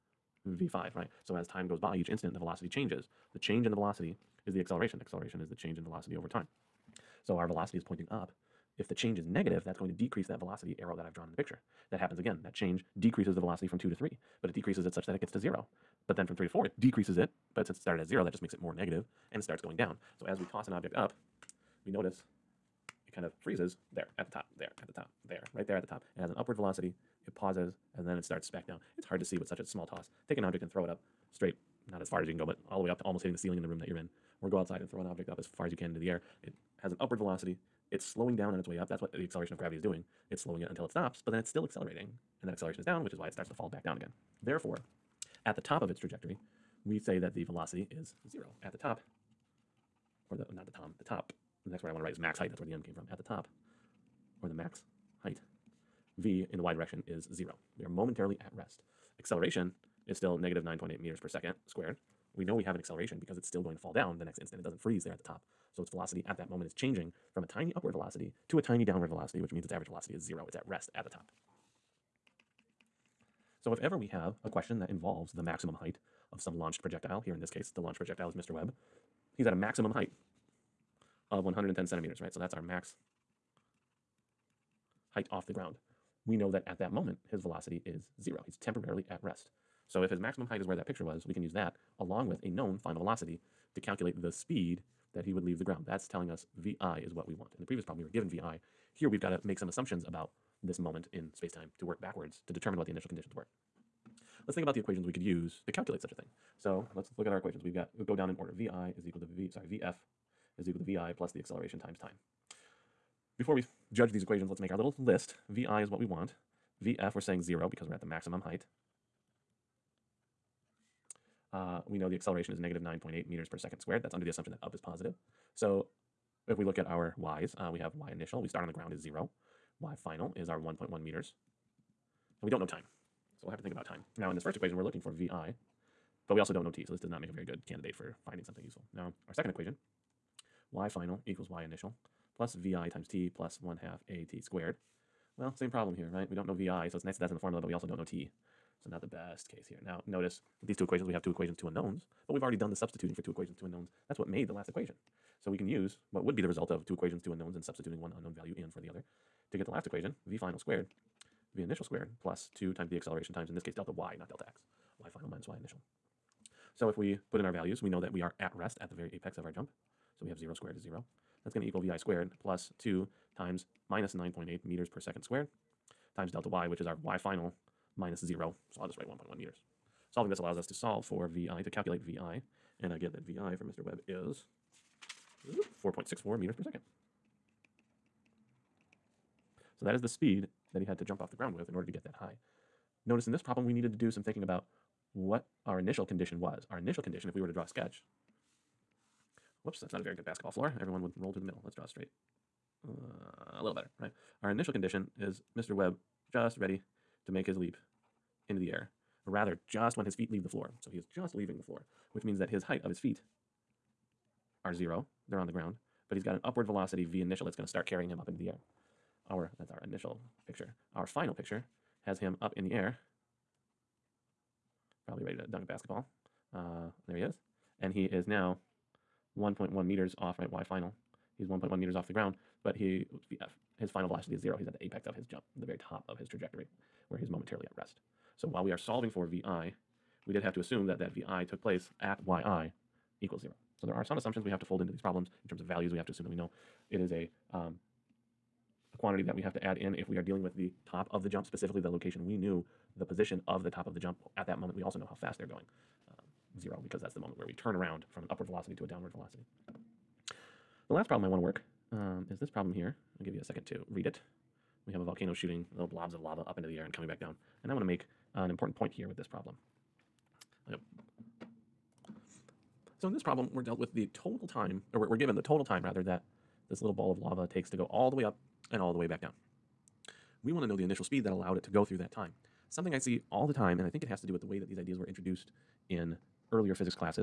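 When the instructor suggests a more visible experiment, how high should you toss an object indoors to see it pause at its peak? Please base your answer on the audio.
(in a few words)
almost hitting the ceiling.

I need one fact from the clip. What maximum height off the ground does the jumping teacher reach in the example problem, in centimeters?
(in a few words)
110 centimeters.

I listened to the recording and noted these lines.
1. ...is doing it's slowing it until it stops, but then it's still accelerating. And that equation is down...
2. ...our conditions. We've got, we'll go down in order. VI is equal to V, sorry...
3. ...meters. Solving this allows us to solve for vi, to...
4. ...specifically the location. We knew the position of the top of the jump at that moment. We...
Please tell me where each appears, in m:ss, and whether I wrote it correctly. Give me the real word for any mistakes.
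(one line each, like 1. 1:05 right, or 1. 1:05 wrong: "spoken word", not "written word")
1. 0:39 wrong: "acceleration", not "equation"
2. 1:47 wrong: "equations", not "conditions"
3. 2:59 right
4. 4:11 right.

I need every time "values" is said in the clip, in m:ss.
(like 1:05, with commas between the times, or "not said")
2:38, 2:47, 4:05.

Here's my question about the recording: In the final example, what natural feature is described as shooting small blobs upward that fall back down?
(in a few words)
volcano.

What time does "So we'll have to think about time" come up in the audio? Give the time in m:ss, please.
2:13.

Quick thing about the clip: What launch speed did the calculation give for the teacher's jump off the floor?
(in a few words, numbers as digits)
4.64 meters per second.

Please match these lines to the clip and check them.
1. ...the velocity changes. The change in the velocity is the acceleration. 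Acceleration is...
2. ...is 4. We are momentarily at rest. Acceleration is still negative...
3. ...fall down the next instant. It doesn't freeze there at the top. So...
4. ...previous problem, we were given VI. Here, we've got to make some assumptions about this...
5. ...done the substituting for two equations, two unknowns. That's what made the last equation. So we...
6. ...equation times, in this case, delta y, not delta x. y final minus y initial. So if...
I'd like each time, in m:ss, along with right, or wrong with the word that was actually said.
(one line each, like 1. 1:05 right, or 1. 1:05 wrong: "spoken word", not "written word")
1. 0:02 right
2. 0:57 wrong: "0", not "4"
3. 1:03 right
4. 1:37 right
5. 2:32 right
6. 2:42 wrong: "acceleration", not "equation".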